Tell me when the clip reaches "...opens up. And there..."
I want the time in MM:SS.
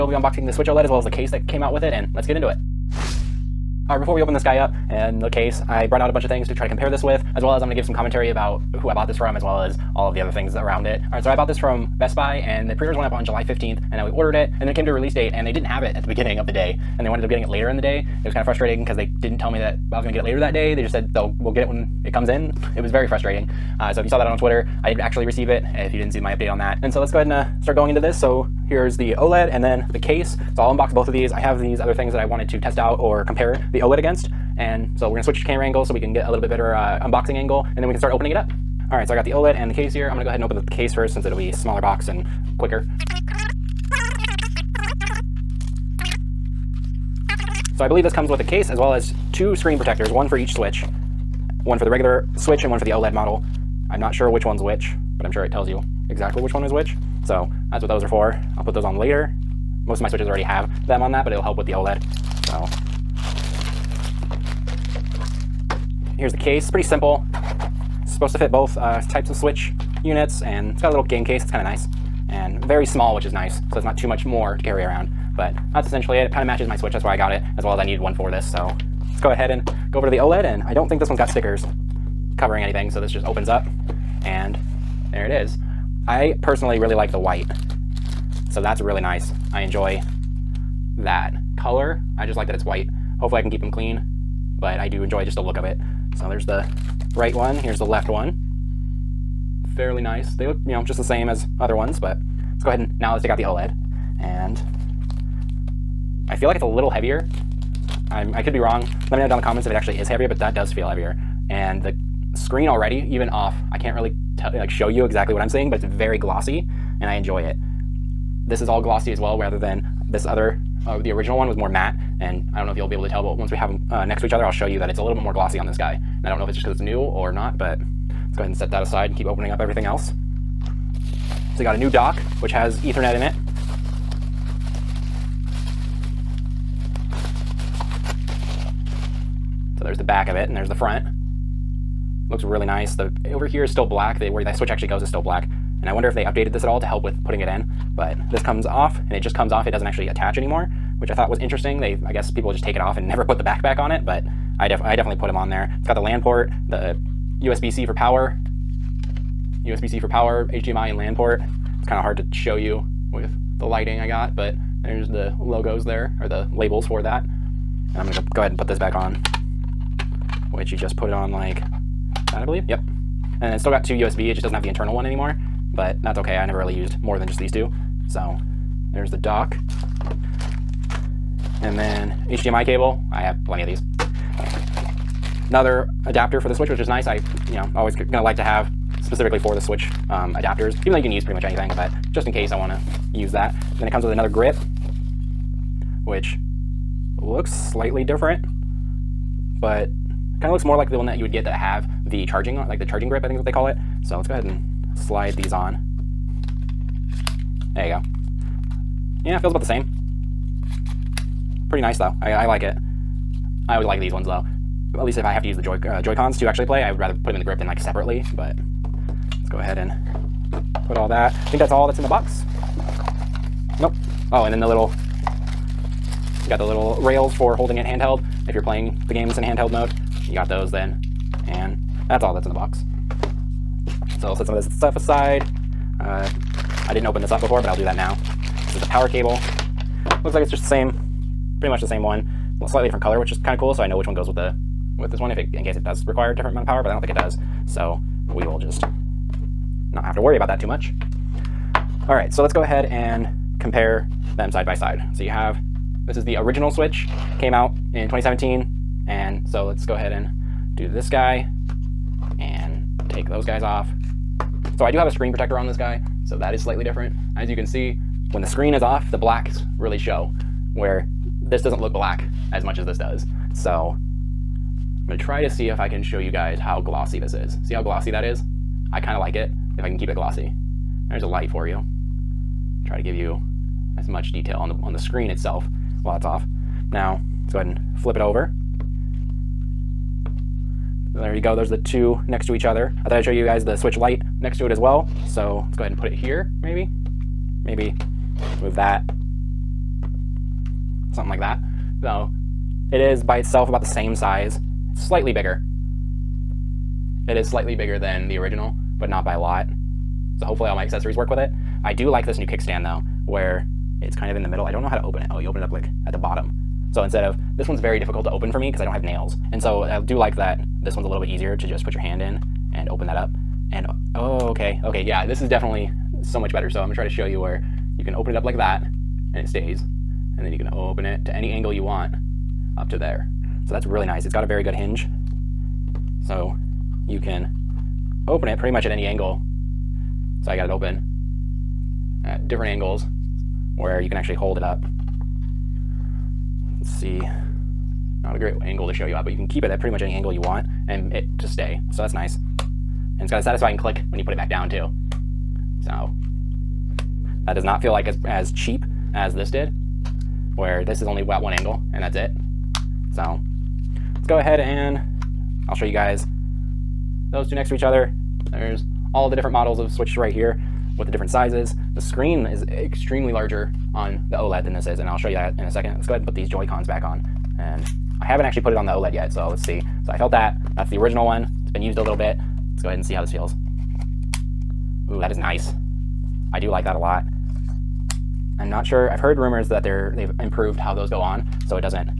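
01:23.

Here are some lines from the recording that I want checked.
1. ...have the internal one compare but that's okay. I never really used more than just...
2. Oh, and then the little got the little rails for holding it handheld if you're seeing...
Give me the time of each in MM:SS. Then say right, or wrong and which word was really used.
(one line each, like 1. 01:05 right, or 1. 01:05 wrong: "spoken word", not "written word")
1. 02:54 wrong: "anymore", not "compare"
2. 03:44 wrong: "playing", not "seeing".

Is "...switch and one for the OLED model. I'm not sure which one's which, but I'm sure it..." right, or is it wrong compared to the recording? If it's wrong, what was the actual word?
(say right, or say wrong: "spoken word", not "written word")
right.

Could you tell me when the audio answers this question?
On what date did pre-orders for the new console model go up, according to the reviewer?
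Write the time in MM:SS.
00:13.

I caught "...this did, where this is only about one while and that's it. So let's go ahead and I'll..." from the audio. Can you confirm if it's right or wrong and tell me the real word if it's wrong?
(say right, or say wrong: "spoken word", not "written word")
wrong: "angle", not "while".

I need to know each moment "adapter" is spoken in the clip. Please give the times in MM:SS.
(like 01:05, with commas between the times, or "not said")
03:06, 03:10.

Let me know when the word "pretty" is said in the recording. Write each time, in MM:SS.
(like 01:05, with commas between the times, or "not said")
01:06, 03:11, 03:31, 04:01, 05:38, 05:49.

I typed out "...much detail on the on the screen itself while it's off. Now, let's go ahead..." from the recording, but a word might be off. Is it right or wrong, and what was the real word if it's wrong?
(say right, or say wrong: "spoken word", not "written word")
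right.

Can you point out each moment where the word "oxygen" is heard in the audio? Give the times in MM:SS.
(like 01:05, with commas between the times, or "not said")
not said.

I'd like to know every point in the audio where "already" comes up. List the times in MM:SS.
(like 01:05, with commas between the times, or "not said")
01:00, 01:52.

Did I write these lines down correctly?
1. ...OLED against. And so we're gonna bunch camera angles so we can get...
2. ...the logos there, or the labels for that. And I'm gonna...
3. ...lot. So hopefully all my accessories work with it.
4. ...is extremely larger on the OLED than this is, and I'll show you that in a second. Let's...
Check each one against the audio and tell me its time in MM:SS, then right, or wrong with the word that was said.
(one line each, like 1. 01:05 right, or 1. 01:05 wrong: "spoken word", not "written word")
1. 00:33 wrong: "switch", not "bunch"
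2. 02:45 right
3. 05:09 right
4. 06:12 right.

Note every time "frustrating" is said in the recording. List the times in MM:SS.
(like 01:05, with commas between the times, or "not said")
00:18, 00:23.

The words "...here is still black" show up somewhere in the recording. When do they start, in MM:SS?
02:23.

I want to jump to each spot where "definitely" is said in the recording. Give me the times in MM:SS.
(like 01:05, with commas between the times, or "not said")
02:34, 05:25.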